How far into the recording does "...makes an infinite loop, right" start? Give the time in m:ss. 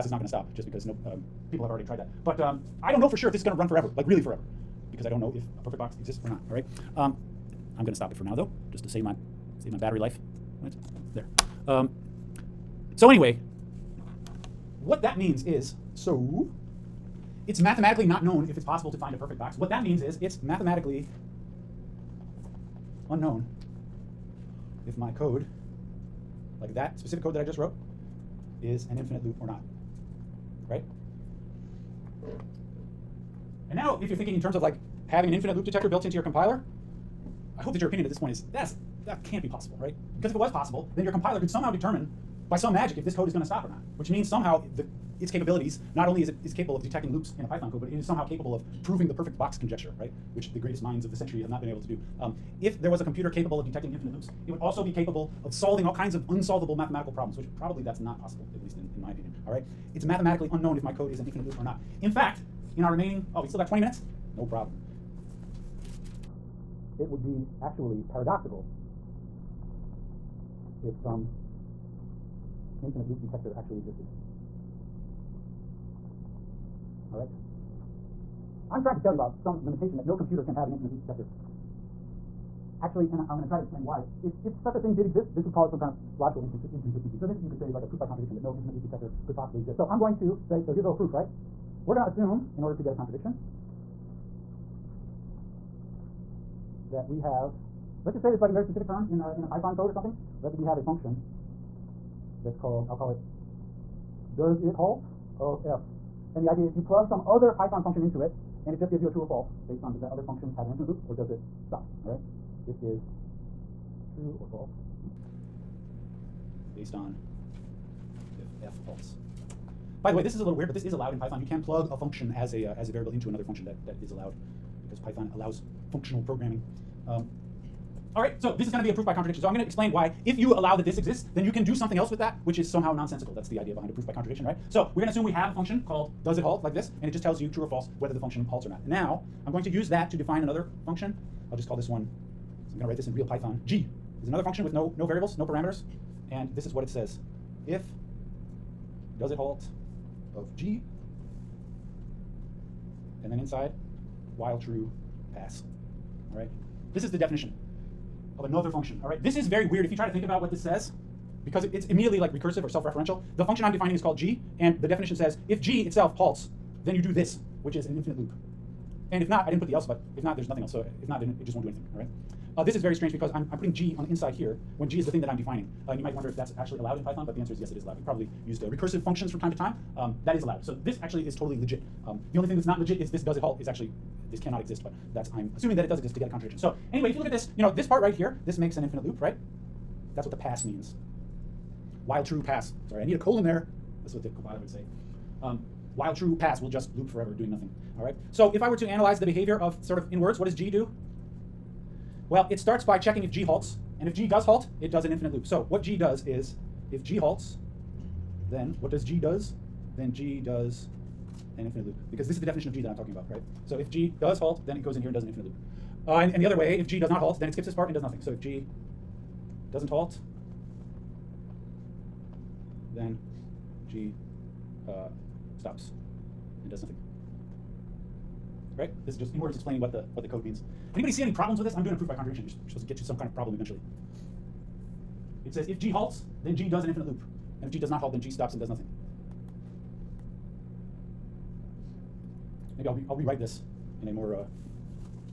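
3:08.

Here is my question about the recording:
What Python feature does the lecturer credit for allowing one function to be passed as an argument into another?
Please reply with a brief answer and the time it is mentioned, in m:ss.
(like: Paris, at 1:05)
Functional programming, at 2:05.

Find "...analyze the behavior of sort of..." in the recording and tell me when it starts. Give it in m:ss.
3:18.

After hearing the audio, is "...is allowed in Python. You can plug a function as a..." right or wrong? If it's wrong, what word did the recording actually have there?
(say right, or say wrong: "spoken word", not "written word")
right.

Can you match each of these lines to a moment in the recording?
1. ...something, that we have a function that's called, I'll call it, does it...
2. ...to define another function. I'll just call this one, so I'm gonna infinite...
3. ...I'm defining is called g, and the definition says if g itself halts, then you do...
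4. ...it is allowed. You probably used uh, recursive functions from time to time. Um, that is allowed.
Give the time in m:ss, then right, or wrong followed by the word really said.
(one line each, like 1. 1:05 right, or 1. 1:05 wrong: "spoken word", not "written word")
1. 1:39 right
2. 2:20 wrong: "write", not "infinite"
3. 2:43 right
4. 2:57 right.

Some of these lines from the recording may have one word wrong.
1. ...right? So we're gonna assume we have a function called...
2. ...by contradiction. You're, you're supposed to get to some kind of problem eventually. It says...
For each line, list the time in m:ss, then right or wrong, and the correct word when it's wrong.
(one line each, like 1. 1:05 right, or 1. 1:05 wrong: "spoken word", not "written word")
1. 2:14 right
2. 3:52 right.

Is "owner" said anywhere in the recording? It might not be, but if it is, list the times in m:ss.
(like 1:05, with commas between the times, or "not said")
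not said.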